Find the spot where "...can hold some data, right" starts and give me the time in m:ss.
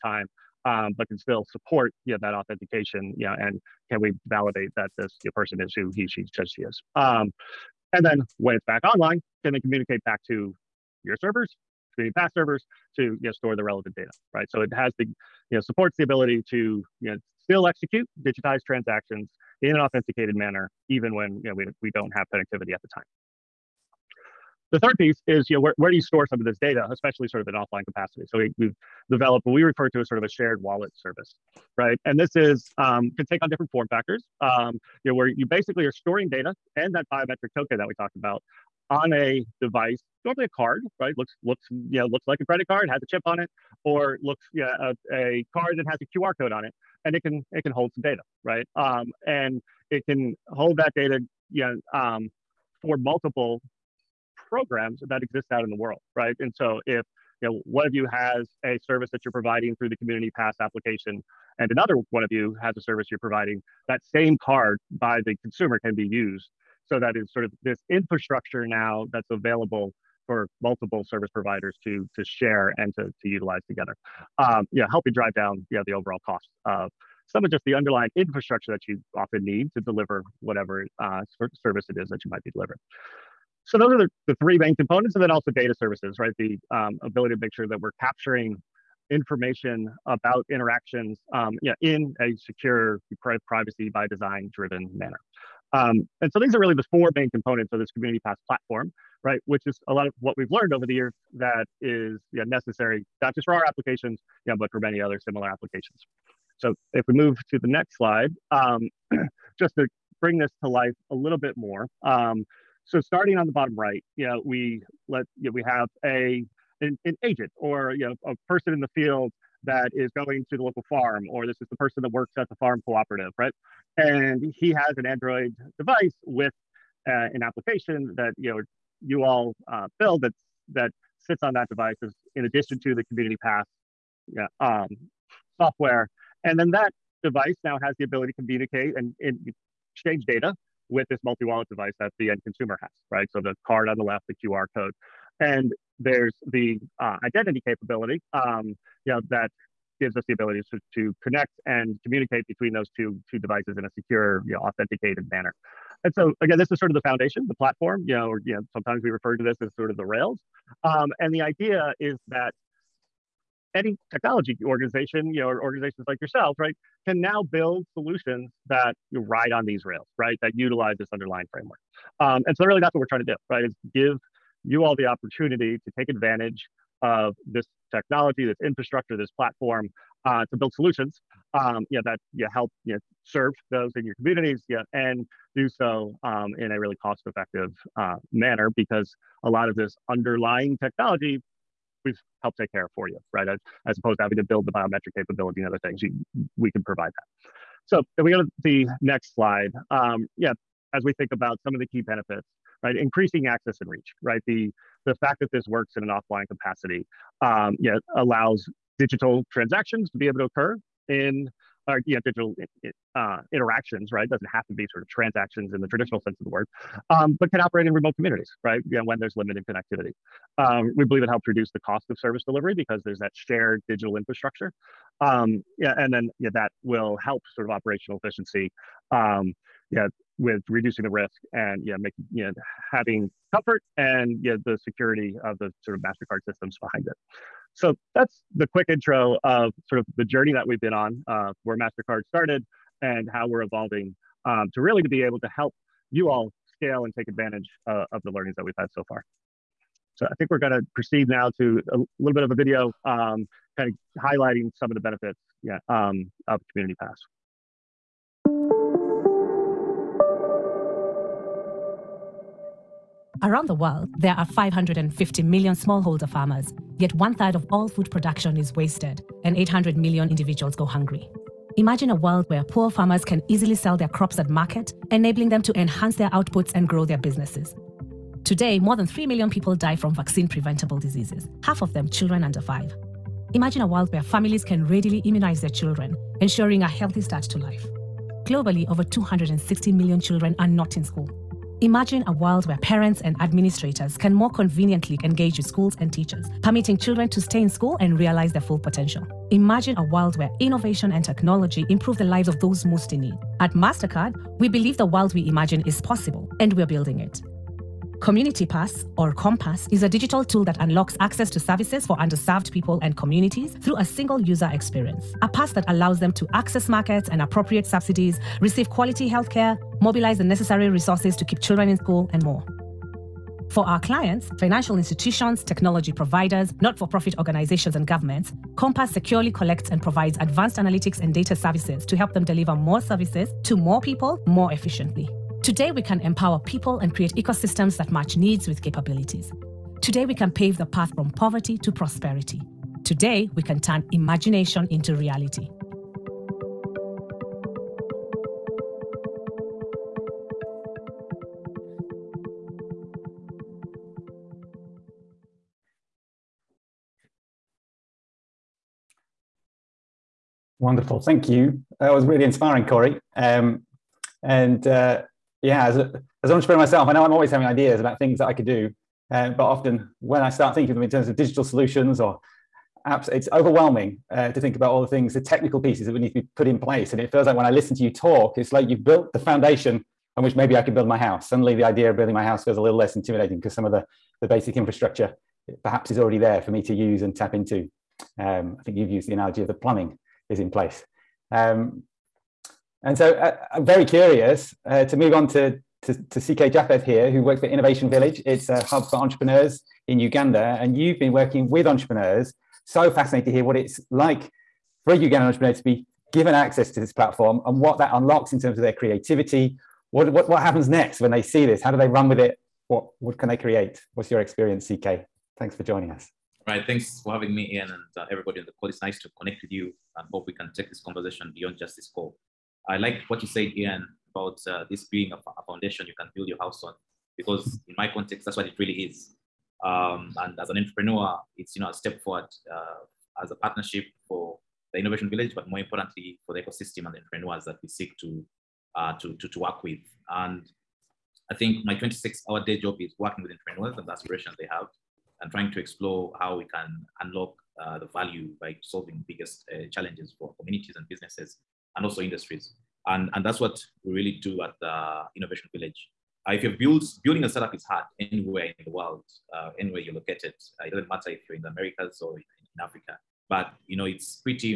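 0:47.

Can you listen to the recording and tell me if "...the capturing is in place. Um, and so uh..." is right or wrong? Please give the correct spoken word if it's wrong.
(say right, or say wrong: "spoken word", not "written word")
wrong: "plumbing", not "capturing".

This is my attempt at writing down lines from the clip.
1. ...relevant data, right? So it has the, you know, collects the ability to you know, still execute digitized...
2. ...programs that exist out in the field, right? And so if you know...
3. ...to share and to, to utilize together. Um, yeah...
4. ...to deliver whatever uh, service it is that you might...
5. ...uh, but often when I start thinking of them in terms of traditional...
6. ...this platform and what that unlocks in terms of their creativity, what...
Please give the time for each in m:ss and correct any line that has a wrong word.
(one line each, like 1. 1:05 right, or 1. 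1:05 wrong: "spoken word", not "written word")
1. 0:13 wrong: "supports", not "collects"
2. 0:54 wrong: "world", not "field"
3. 1:12 right
4. 1:19 right
5. 6:09 wrong: "digital", not "traditional"
6. 6:46 right.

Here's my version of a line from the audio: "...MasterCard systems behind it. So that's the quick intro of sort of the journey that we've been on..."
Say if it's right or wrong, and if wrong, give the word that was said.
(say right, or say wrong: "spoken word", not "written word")
right.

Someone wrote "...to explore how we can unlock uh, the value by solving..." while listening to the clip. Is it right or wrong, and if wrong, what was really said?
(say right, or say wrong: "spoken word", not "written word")
right.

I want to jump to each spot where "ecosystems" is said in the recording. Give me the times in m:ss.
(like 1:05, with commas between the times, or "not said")
5:37, 7:16.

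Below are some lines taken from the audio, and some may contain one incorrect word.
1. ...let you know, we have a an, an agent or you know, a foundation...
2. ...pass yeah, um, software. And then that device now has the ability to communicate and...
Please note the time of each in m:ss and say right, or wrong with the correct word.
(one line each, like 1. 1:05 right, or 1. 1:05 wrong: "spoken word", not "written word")
1. 1:55 wrong: "person", not "foundation"
2. 2:13 right.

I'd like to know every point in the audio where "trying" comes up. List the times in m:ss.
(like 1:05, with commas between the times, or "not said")
2:53, 7:25.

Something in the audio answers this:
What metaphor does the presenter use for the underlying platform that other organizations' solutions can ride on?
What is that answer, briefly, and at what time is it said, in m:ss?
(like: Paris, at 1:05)
the rails, at 2:39.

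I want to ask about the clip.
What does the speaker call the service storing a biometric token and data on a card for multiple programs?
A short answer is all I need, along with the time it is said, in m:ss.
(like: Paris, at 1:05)
shared wallet service, at 0:30.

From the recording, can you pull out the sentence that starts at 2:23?
So the card on the left, the QR code.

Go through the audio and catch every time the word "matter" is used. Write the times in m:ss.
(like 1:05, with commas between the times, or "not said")
7:41.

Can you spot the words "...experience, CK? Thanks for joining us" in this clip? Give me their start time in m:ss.
6:54.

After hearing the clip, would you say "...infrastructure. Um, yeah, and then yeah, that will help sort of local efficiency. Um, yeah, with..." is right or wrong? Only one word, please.
wrong.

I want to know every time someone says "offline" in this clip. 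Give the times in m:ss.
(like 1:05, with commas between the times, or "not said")
0:27, 3:26.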